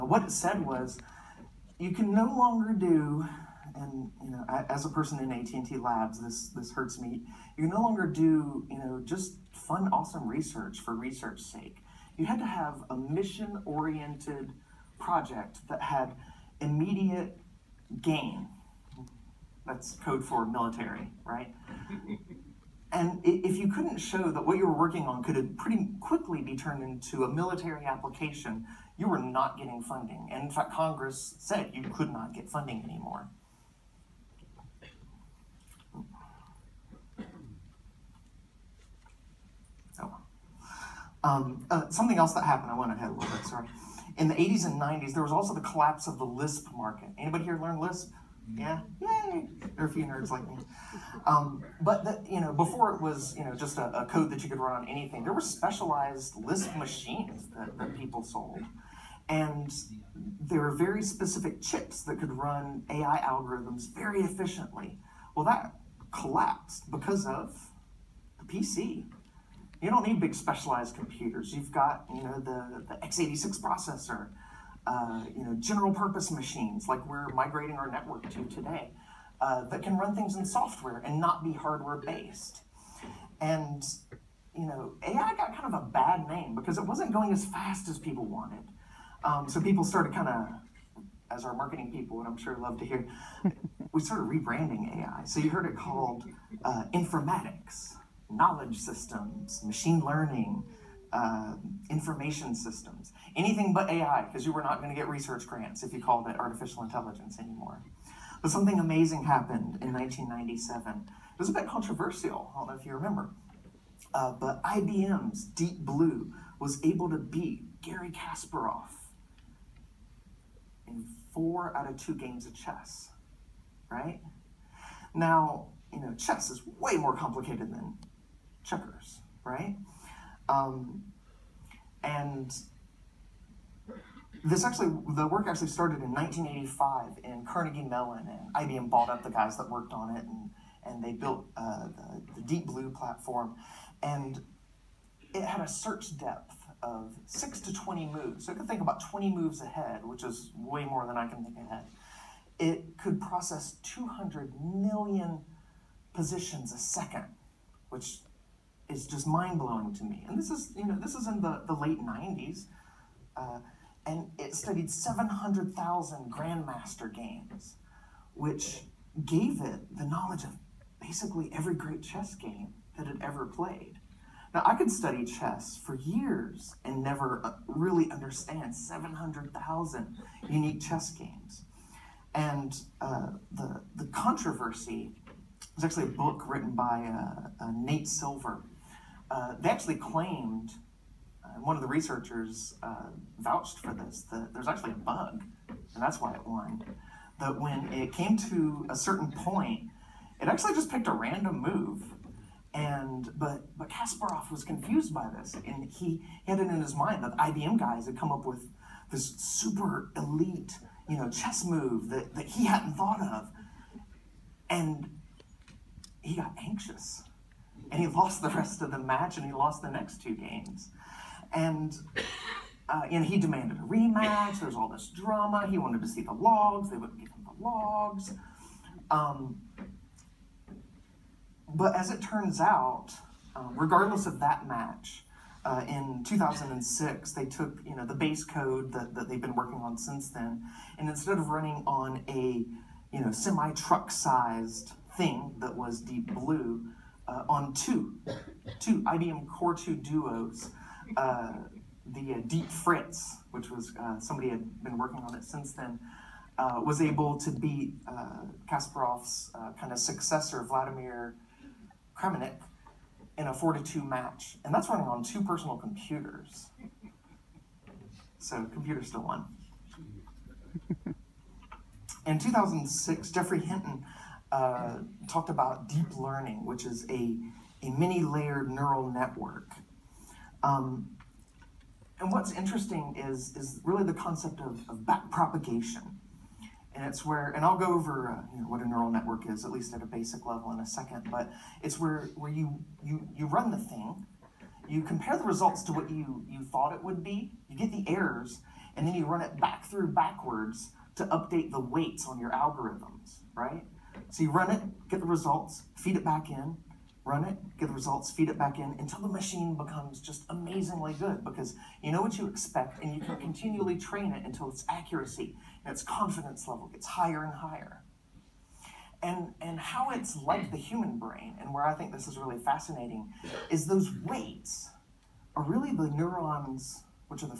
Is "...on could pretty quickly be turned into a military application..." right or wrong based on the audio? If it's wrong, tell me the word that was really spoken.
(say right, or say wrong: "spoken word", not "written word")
right.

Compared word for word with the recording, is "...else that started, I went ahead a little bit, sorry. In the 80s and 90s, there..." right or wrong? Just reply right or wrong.
wrong.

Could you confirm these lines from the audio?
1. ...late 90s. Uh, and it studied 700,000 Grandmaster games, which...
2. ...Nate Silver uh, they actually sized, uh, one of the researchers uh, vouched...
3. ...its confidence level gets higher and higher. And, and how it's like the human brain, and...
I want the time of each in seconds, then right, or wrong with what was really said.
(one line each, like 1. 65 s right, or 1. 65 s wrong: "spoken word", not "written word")
1. 161 s right
2. 187 s wrong: "claimed", not "sized"
3. 315 s right.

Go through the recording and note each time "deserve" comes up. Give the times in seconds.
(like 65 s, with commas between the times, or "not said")
not said.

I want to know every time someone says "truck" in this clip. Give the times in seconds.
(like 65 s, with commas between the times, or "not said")
243 s.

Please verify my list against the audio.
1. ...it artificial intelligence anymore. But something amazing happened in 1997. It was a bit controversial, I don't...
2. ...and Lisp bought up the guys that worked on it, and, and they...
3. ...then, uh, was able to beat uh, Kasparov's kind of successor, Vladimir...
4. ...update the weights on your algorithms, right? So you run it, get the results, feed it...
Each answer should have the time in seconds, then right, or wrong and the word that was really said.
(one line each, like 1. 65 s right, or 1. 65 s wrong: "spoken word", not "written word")
1. 106 s right
2. 138 s wrong: "IBM", not "Lisp"
3. 255 s right
4. 301 s right.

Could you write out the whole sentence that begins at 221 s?
And uh, you know, he demanded a rematch.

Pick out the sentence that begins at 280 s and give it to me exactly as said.
Um, and what's interesting is, is really the concept of, of backpropagation.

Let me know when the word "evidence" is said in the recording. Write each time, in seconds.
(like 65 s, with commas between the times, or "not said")
not said.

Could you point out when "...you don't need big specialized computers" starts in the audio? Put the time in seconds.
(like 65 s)
69 s.